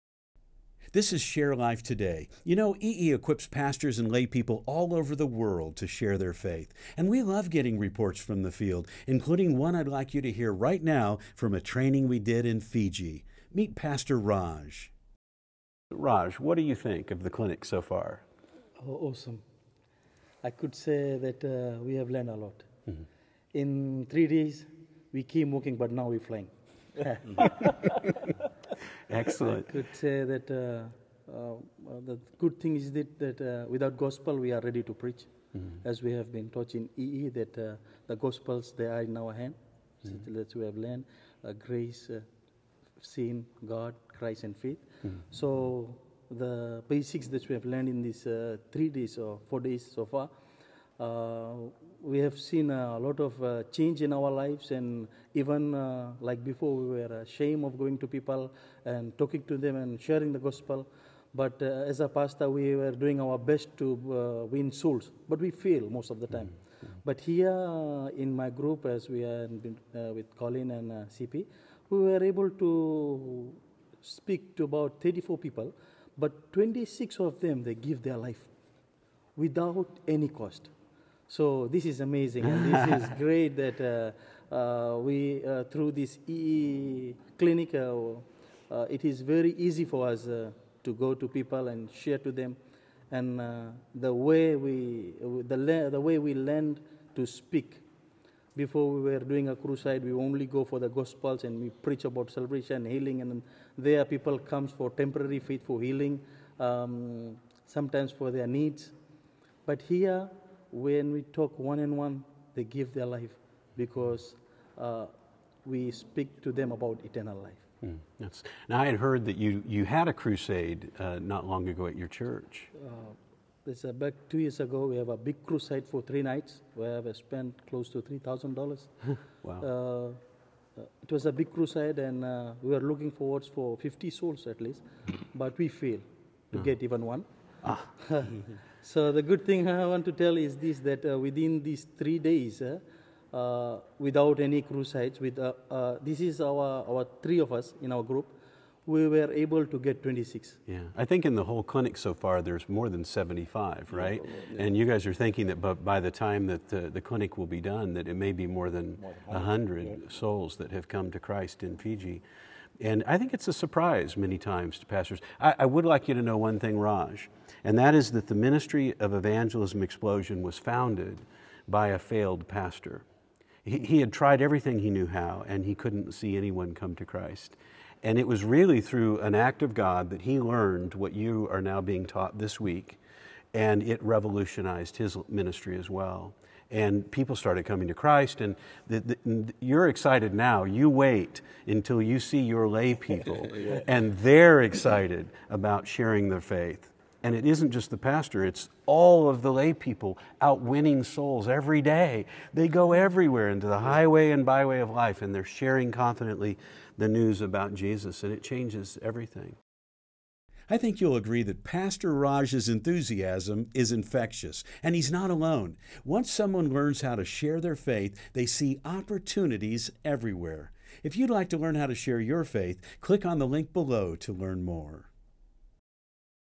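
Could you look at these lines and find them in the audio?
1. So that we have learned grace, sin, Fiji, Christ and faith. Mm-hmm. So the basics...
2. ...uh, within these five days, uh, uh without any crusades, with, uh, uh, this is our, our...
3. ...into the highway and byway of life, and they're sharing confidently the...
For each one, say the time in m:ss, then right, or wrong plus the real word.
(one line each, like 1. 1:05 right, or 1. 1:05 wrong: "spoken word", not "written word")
1. 0:40 wrong: "God", not "Fiji"
2. 2:21 wrong: "three", not "five"
3. 3:23 right.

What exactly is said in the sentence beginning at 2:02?
Uh, it's about two years ago.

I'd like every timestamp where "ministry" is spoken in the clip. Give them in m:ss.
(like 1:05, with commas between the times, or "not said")
2:48, 3:05.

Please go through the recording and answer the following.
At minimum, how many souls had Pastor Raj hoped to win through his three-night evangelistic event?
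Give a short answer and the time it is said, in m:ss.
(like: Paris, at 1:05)
50, at 2:13.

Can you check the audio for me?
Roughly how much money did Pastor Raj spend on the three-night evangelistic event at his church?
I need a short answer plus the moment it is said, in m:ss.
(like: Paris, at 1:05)
$3,000, at 2:07.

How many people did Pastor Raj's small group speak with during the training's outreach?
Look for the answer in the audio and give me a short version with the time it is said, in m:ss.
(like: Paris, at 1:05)
34, at 1:15.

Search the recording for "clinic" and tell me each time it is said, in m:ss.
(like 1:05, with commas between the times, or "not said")
0:17, 1:27, 2:31, 2:36.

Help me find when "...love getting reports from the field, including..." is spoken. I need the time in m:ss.
0:07.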